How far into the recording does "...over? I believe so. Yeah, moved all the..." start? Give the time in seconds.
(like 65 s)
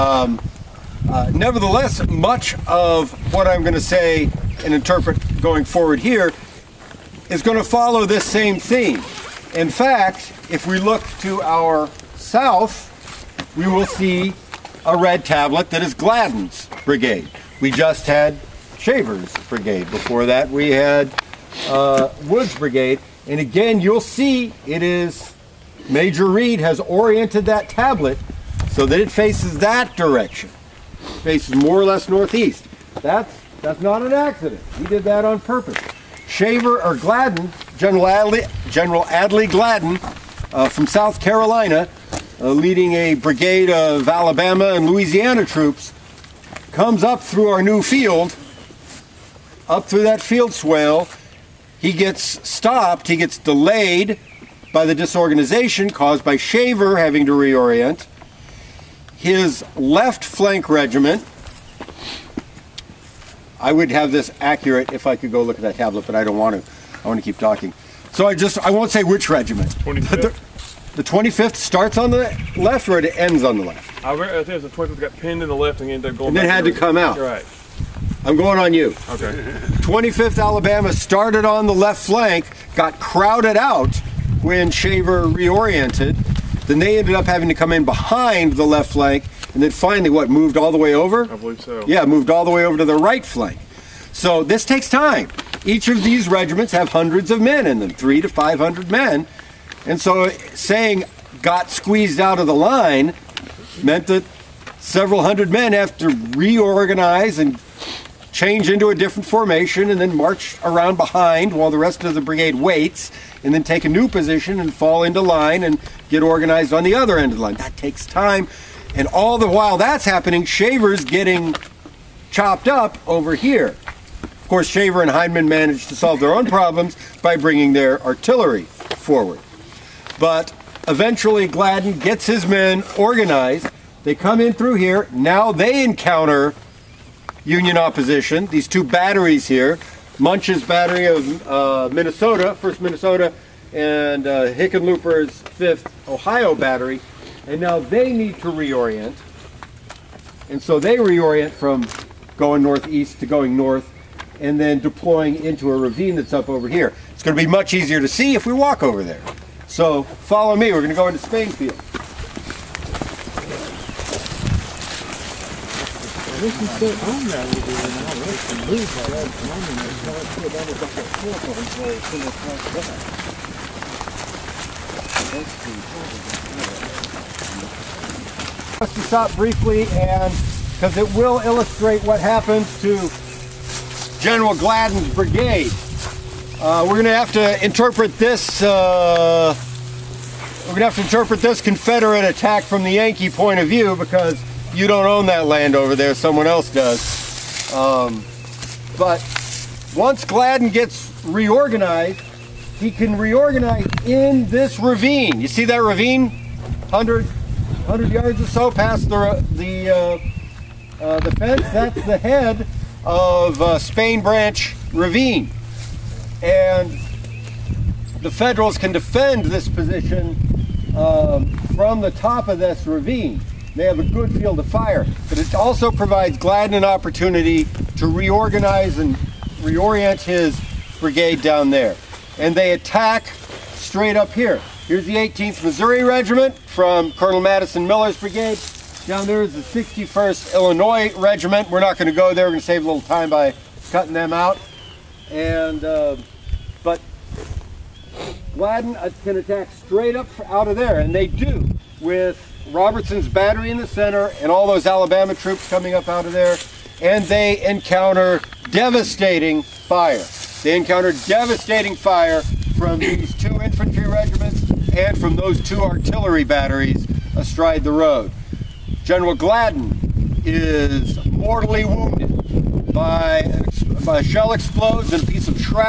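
90 s.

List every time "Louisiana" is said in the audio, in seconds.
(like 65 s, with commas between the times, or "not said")
44 s.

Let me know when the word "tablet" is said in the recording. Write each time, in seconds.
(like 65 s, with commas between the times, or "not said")
15 s, 27 s, 65 s.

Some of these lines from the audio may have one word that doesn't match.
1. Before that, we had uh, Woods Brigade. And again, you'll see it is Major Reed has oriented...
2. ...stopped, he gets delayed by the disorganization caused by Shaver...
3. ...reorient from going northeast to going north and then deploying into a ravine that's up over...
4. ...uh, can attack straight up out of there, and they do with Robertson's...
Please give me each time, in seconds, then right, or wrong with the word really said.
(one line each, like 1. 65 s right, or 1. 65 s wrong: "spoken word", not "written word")
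1. 19 s right
2. 52 s right
3. 150 s right
4. 248 s right.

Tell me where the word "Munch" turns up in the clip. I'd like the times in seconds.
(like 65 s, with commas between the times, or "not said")
140 s.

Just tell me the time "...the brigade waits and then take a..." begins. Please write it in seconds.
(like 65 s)
112 s.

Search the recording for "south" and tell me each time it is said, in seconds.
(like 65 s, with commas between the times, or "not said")
12 s, 40 s.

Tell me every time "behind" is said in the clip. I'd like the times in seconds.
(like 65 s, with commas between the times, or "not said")
87 s, 110 s.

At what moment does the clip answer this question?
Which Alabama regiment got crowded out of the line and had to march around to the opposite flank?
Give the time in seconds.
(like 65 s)
79 s.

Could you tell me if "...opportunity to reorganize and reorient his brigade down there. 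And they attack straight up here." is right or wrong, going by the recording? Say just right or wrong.
right.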